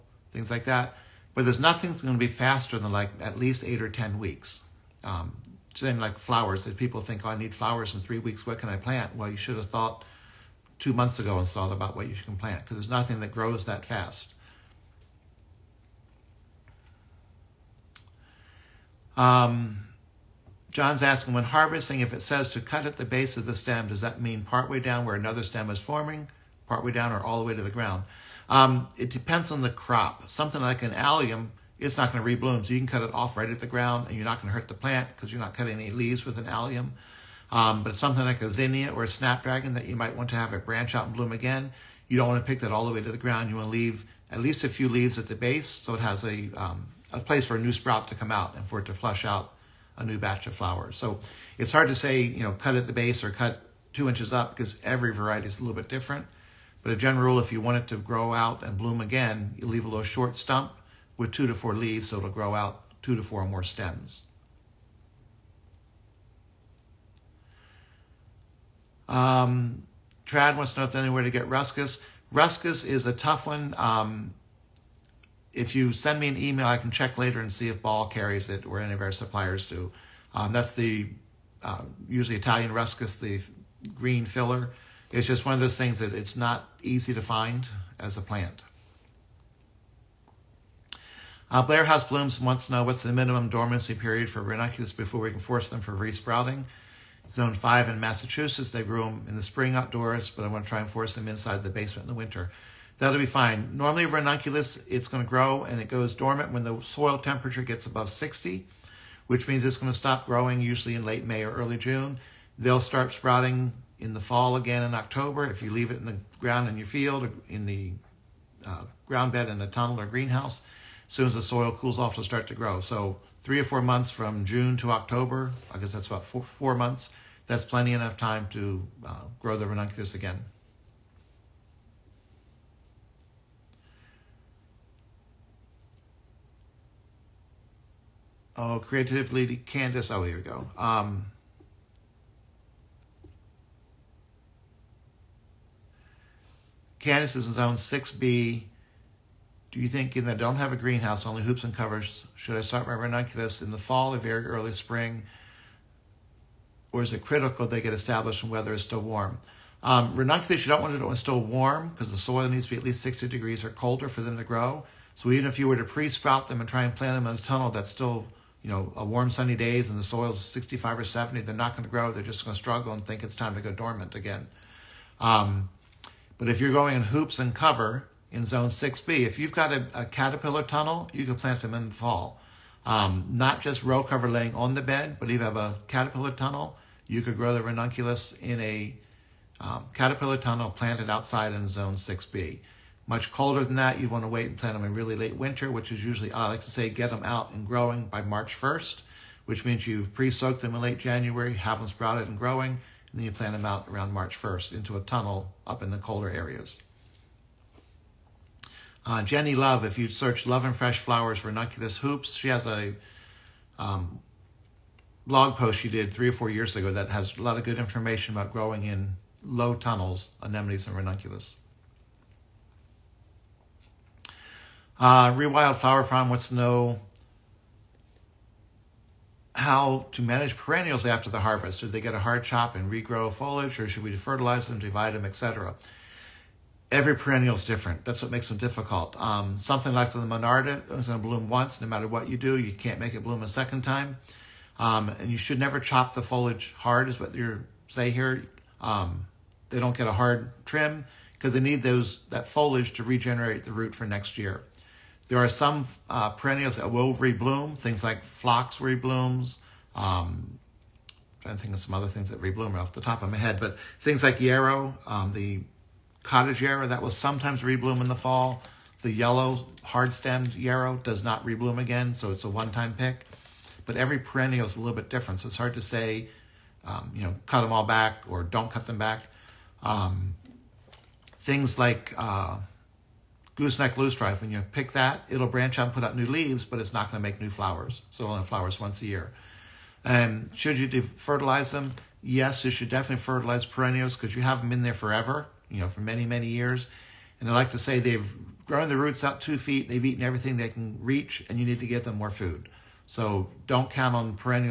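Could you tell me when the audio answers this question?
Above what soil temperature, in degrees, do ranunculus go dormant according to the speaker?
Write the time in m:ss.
1:47.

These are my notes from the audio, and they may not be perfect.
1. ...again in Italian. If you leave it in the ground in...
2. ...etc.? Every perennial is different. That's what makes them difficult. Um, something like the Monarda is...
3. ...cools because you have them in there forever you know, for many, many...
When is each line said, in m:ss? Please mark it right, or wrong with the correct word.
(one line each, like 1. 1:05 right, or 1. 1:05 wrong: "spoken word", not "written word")
1. 1:54 wrong: "October", not "Italian"
2. 3:55 right
3. 4:53 wrong: "perennials", not "cools".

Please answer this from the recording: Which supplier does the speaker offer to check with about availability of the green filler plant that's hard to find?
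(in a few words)
Ball.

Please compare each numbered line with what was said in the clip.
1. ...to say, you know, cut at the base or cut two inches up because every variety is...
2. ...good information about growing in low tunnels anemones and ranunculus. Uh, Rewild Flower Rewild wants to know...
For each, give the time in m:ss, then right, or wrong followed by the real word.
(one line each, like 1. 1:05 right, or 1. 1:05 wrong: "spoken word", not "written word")
1. 0:51 right
2. 3:37 wrong: "Farm", not "Rewild".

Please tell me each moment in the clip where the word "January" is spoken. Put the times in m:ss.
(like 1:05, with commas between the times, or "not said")
3:20.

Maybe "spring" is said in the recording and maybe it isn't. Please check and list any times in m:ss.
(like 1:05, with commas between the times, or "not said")
1:39, 2:34.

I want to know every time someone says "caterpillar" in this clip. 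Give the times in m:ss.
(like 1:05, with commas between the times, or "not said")
3:00, 3:05, 3:09.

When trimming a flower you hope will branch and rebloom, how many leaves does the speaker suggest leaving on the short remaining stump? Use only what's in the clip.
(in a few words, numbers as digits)
2 to 4.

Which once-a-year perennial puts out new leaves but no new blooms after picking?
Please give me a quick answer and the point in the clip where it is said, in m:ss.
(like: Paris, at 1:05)
Gooseneck loosestrife, at 4:43.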